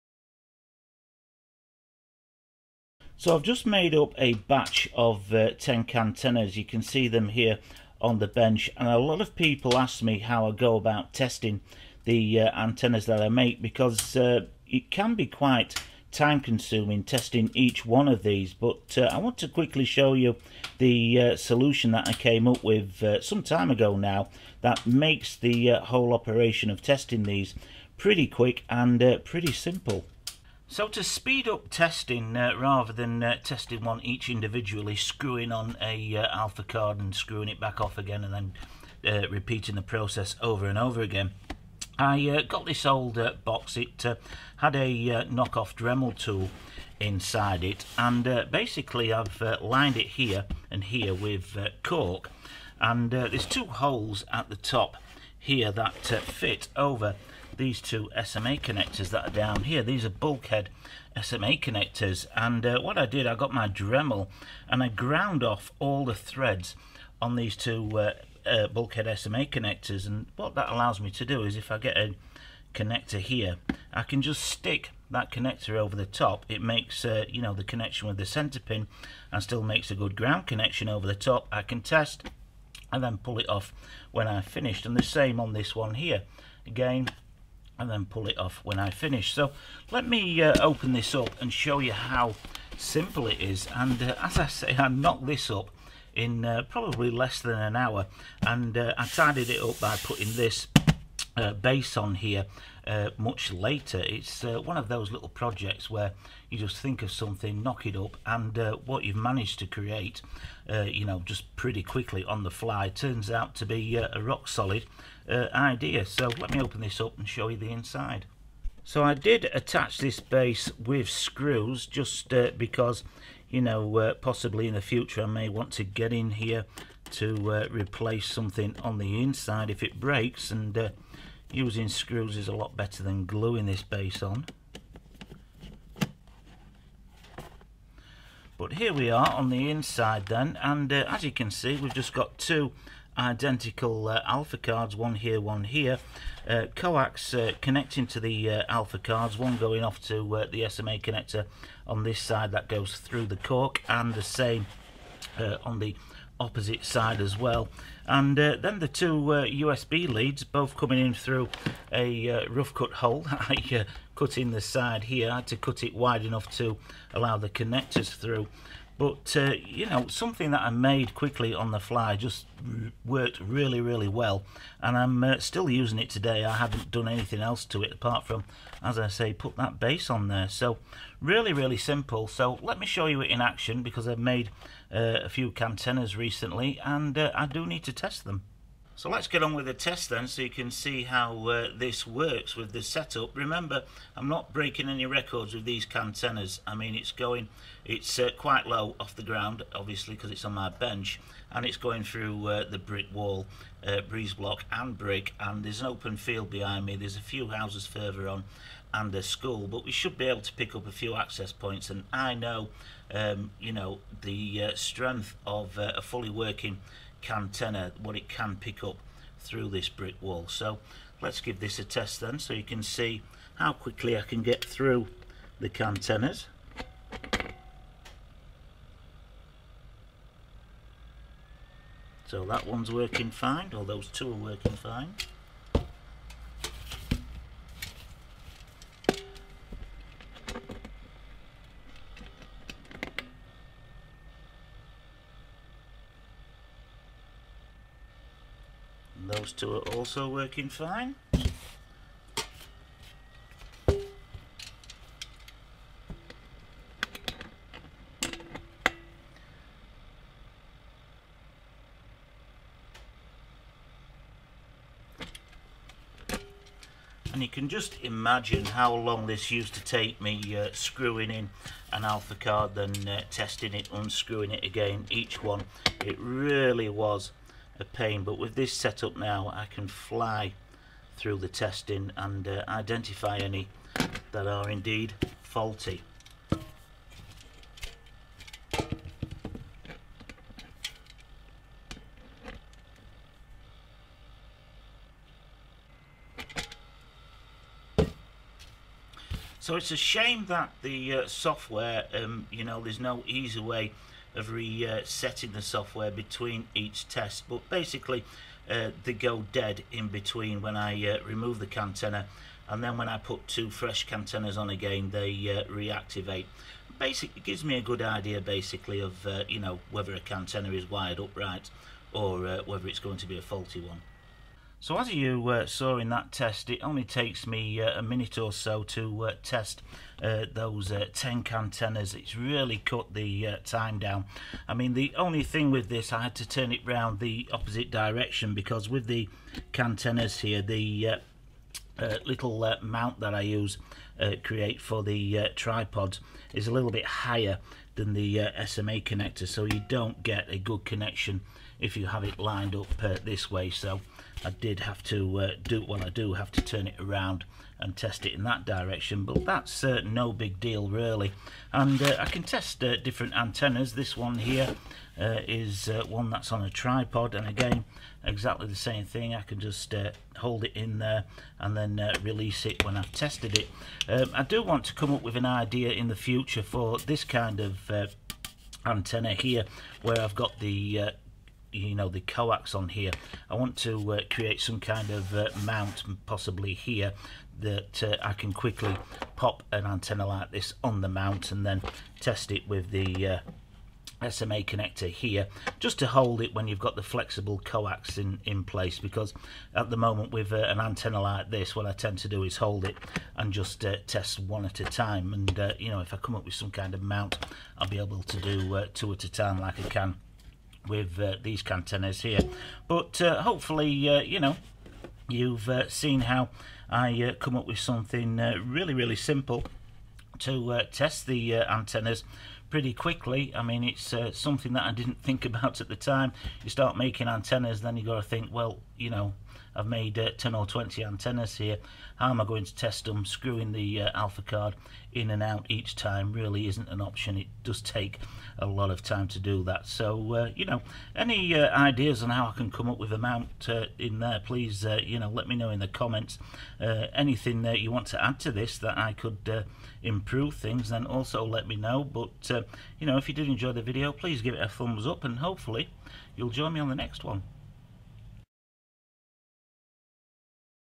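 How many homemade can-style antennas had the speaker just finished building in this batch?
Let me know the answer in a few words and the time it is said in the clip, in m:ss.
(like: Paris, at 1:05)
10, at 0:05.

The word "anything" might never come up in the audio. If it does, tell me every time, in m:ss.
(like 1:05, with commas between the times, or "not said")
2:57, 7:26.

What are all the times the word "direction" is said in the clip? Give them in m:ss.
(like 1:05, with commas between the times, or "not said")
5:37, 5:58.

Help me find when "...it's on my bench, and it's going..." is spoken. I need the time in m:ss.
3:20.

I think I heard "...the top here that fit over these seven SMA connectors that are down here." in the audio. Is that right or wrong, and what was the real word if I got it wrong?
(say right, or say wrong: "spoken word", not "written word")
wrong: "two", not "seven".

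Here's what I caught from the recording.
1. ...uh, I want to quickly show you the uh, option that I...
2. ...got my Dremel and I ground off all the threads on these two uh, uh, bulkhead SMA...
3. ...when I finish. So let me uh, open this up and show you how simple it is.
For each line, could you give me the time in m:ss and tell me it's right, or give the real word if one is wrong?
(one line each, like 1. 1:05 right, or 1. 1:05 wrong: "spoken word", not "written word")
1. 0:18 wrong: "solution", not "option"
2. 1:03 right
3. 1:28 right.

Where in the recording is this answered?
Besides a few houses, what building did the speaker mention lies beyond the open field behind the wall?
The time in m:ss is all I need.
3:29.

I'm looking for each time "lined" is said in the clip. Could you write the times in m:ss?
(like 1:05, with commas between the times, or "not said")
0:49, 5:52.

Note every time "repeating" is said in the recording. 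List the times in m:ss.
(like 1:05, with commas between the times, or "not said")
0:39.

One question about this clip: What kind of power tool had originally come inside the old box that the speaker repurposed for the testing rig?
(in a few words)
knockoff Dremel tool.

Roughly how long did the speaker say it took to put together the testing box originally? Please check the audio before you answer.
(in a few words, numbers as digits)
less than an hour.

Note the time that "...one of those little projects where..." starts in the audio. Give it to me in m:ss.
1:44.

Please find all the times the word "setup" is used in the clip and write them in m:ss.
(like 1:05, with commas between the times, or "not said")
3:12, 4:38.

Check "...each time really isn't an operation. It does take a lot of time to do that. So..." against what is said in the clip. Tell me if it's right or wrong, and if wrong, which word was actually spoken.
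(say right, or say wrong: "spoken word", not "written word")
wrong: "option", not "operation".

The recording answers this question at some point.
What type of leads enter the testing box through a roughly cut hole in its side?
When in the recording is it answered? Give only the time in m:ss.
2:39.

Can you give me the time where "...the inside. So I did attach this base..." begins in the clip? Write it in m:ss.
1:57.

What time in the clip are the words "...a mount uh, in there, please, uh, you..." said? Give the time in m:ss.
7:23.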